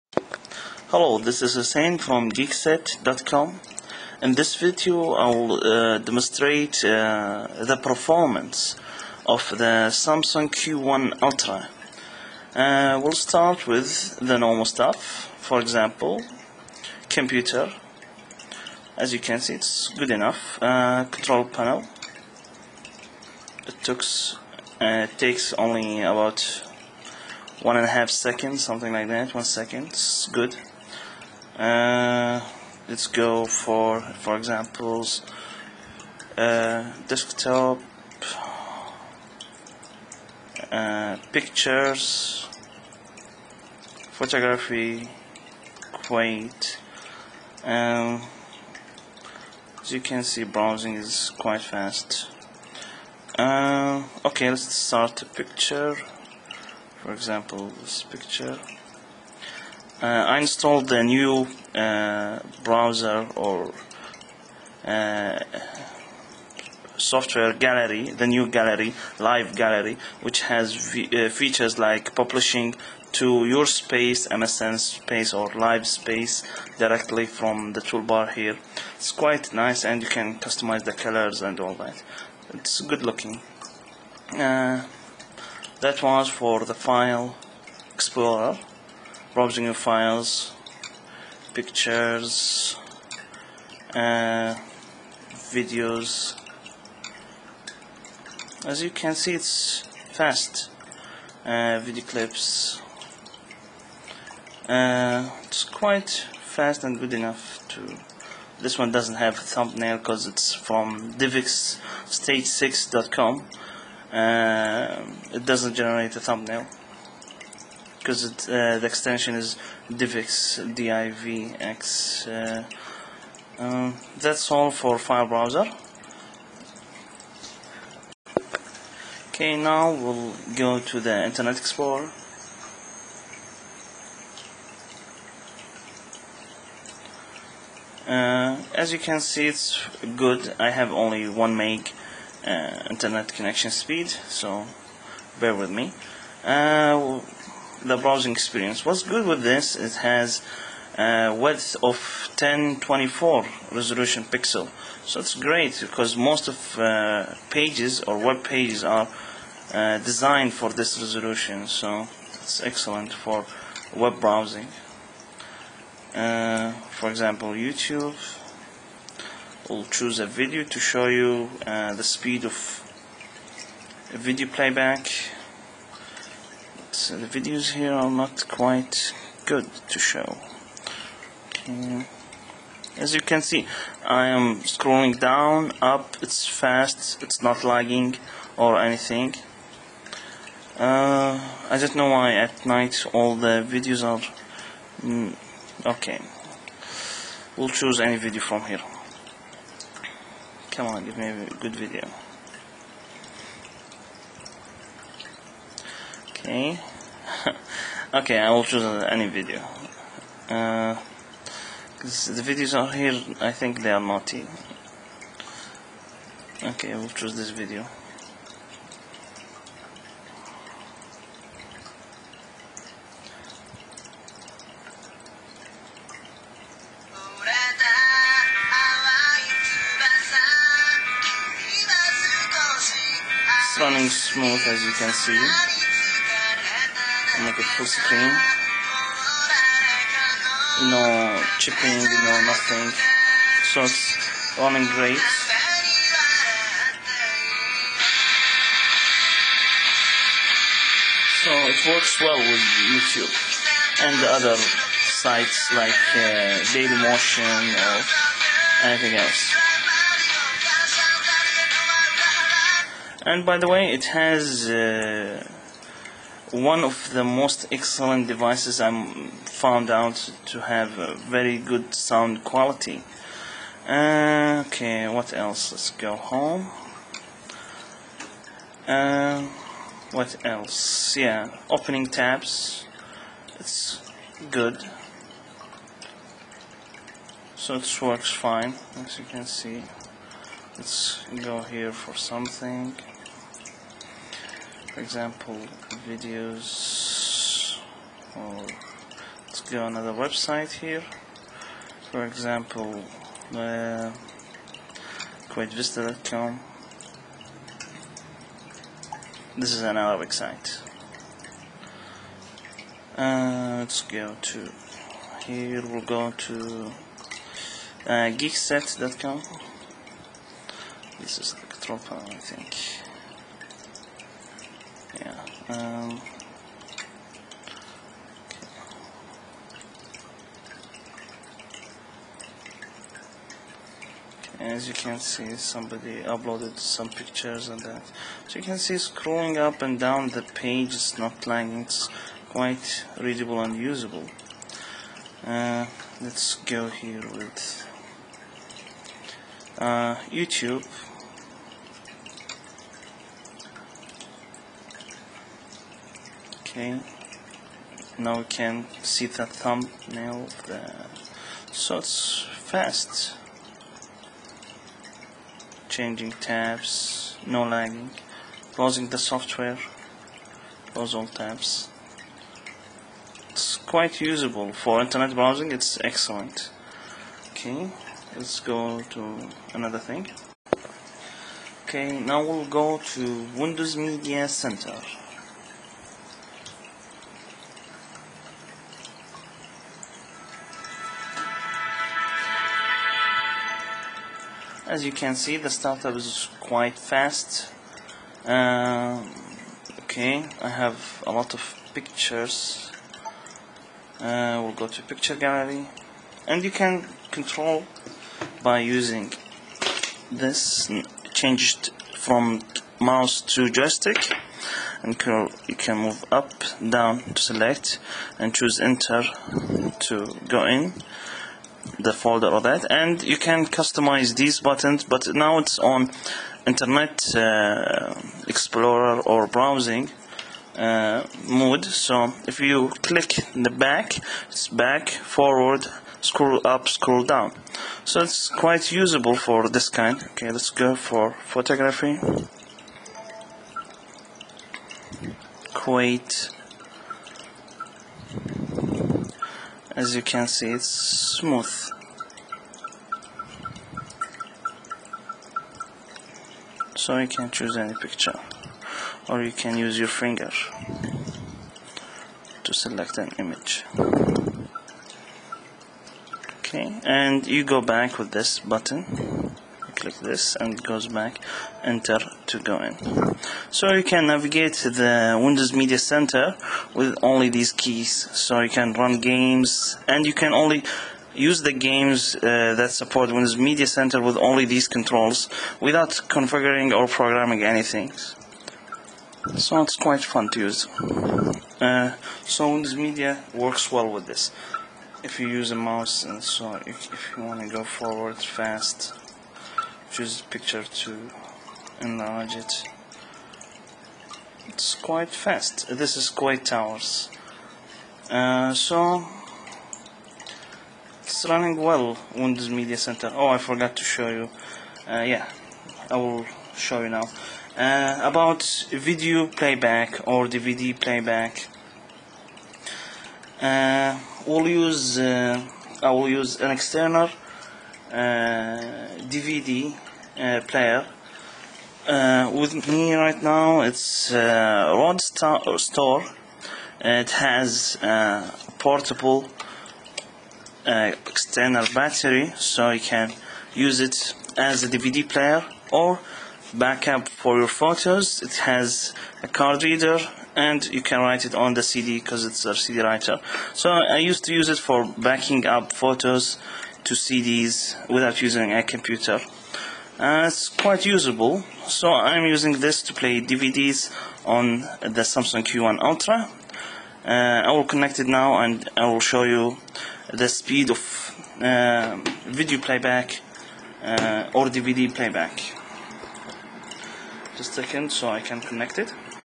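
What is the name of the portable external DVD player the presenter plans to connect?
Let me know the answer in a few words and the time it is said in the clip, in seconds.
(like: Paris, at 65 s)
Rod Store, at 534 s.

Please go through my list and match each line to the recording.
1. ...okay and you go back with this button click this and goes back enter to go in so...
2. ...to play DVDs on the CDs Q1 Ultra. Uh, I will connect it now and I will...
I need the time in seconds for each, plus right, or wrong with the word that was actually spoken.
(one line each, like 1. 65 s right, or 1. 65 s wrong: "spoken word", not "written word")
1. 466 s right
2. 563 s wrong: "Samsung", not "CDs".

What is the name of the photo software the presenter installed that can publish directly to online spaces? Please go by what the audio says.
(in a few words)
Live Gallery.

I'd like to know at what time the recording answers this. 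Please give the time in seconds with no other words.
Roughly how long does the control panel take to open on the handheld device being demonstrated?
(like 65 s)
27 s.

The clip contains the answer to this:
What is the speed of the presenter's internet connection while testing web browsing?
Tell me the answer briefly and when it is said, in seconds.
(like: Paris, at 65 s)
1 meg, at 141 s.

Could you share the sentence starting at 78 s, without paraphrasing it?
It's quite nice and you can customize the colors and all that.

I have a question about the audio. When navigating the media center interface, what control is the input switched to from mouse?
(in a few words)
joystick.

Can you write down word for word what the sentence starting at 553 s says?
So I used to use it for backing up photos to CDs without using a computer.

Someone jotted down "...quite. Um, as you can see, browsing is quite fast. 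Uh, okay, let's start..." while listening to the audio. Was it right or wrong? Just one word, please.
right.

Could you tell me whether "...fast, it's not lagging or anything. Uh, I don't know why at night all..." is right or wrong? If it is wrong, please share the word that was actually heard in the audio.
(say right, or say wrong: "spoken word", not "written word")
right.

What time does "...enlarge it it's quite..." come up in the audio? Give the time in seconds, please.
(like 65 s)
502 s.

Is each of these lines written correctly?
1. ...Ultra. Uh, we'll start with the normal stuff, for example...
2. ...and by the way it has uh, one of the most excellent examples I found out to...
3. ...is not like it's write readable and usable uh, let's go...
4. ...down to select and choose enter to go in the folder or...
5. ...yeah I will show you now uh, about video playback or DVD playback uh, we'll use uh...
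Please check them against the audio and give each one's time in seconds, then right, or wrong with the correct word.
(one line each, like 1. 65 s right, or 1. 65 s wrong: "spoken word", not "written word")
1. 11 s right
2. 263 s wrong: "devices", not "examples"
3. 340 s wrong: "quite", not "write"
4. 416 s right
5. 515 s right.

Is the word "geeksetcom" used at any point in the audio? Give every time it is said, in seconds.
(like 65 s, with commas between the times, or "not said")
2 s, 318 s.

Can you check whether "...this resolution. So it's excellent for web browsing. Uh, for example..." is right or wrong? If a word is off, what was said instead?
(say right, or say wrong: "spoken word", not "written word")
right.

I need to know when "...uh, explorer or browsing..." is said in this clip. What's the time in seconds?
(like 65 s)
427 s.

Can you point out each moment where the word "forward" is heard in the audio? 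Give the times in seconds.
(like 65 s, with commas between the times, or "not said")
435 s, 497 s.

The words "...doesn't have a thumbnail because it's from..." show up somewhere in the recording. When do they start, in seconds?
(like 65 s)
108 s.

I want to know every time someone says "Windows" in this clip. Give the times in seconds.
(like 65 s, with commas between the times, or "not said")
383 s, 475 s, 483 s, 492 s, 512 s.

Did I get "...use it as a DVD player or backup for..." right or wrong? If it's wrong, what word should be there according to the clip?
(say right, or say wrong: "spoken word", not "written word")
right.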